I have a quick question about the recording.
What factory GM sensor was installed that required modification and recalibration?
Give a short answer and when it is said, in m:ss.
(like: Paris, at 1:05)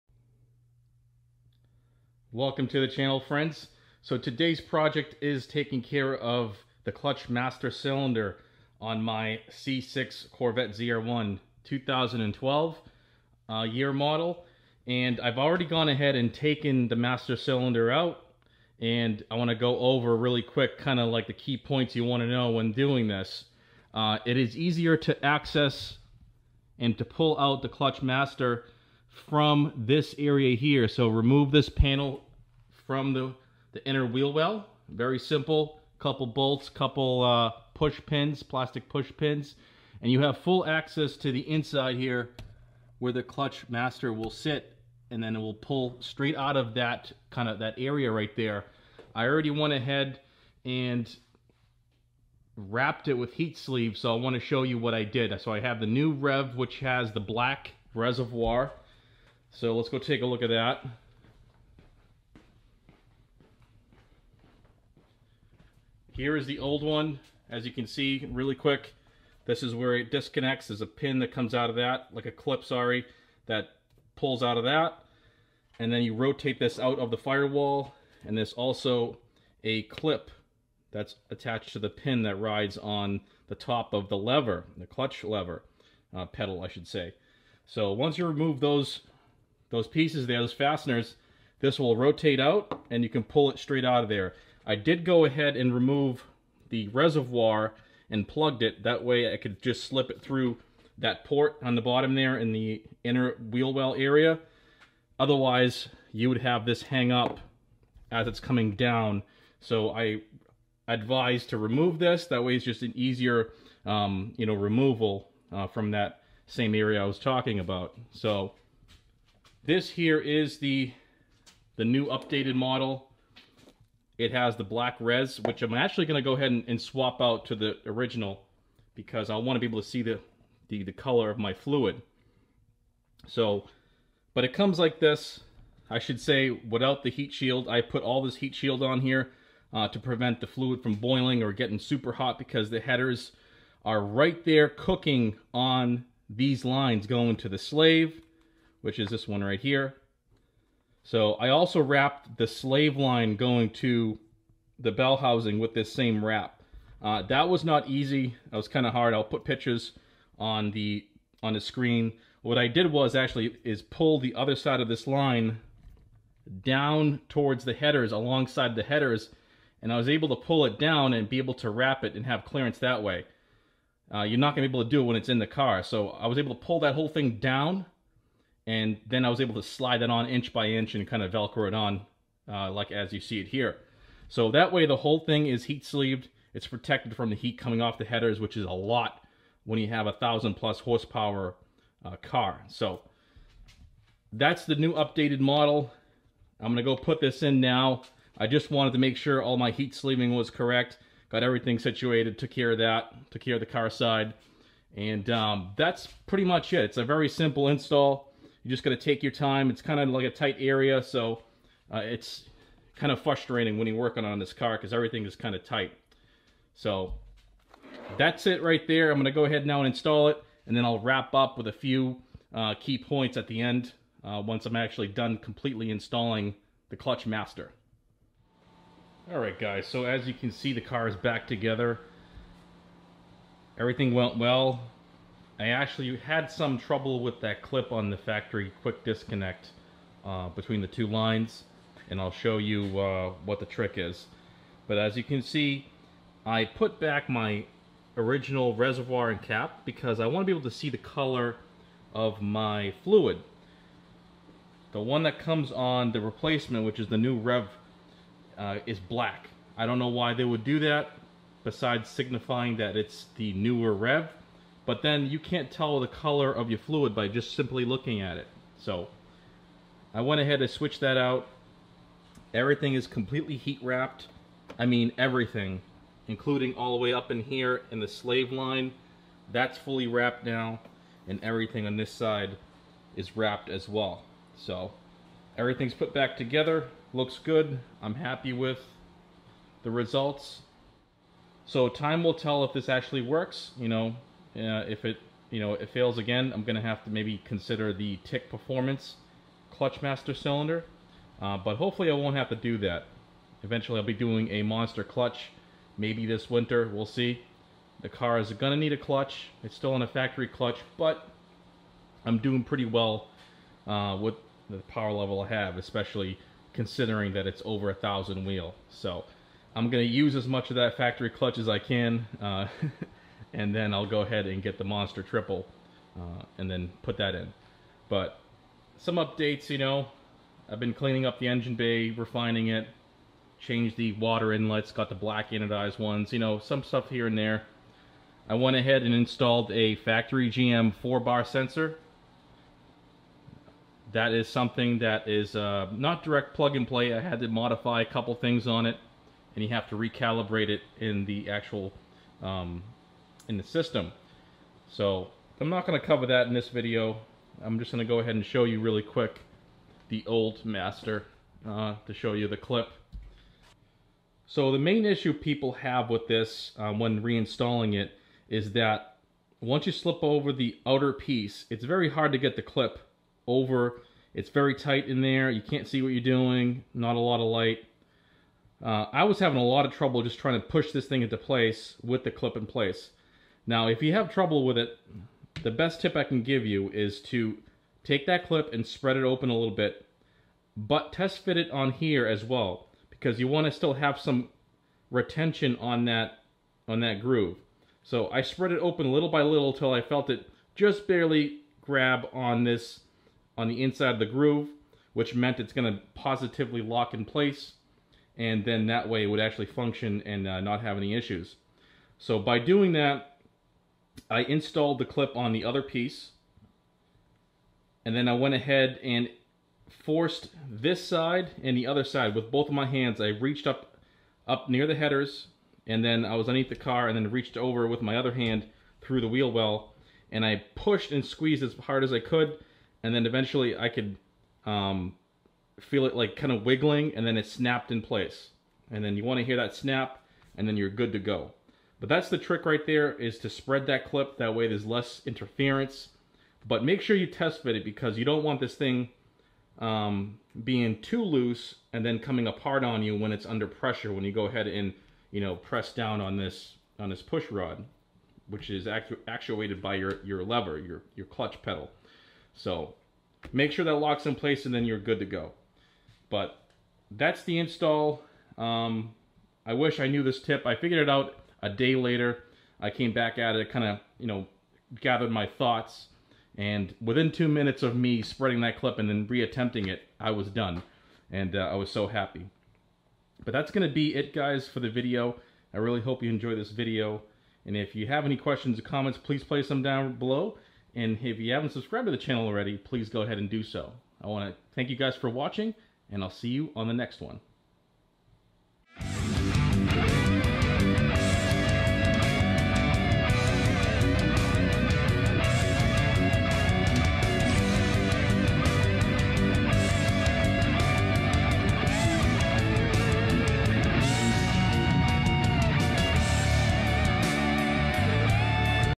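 4-bar sensor, at 5:41.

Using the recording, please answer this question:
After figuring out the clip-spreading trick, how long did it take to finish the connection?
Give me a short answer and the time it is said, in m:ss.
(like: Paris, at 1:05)
2 minutes, at 7:57.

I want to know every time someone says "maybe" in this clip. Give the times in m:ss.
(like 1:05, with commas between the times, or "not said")
4:57, 5:05.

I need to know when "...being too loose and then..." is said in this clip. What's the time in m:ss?
7:30.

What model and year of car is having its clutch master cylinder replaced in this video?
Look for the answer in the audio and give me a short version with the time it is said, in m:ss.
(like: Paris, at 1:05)
2012 C6 Corvette ZR1, at 0:09.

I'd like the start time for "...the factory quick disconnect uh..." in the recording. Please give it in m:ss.
3:58.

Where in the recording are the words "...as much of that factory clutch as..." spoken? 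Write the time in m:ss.
5:20.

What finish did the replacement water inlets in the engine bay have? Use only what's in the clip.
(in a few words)
black anodized.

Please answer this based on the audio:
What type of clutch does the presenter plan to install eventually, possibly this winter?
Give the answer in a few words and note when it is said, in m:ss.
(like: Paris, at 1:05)
monster triple, at 5:24.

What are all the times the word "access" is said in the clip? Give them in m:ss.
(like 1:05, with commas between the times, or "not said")
0:25, 0:40.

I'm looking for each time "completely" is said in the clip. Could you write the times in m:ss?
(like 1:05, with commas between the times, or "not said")
3:45, 4:33.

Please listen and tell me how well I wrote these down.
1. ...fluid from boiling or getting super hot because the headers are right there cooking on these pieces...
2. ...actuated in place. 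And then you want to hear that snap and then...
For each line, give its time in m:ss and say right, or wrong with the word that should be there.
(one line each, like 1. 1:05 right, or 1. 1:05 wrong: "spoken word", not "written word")
1. 2:20 wrong: "lines", not "pieces"
2. 7:17 wrong: "snapped", not "actuated".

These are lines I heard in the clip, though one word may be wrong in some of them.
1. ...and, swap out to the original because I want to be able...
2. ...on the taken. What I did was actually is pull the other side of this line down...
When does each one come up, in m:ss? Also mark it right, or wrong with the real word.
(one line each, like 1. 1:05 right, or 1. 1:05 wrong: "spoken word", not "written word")
1. 2:06 right
2. 2:41 wrong: "screen", not "taken".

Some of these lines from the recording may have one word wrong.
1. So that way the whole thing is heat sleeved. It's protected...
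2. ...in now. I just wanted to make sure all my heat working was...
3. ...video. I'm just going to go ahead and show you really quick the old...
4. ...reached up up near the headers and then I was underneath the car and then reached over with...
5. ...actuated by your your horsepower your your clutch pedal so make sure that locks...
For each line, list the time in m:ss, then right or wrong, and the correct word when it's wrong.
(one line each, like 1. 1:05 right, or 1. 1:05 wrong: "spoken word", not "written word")
1. 3:04 right
2. 3:17 wrong: "sleeving", not "working"
3. 5:56 right
4. 7:03 right
5. 7:39 wrong: "lever", not "horsepower".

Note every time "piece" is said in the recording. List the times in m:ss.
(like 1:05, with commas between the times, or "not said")
1:29, 6:11, 6:55.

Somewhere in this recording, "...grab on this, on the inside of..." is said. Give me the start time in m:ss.
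6:41.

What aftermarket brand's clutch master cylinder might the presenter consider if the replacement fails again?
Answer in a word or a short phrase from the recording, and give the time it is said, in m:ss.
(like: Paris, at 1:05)
Tick Performance, at 4:58.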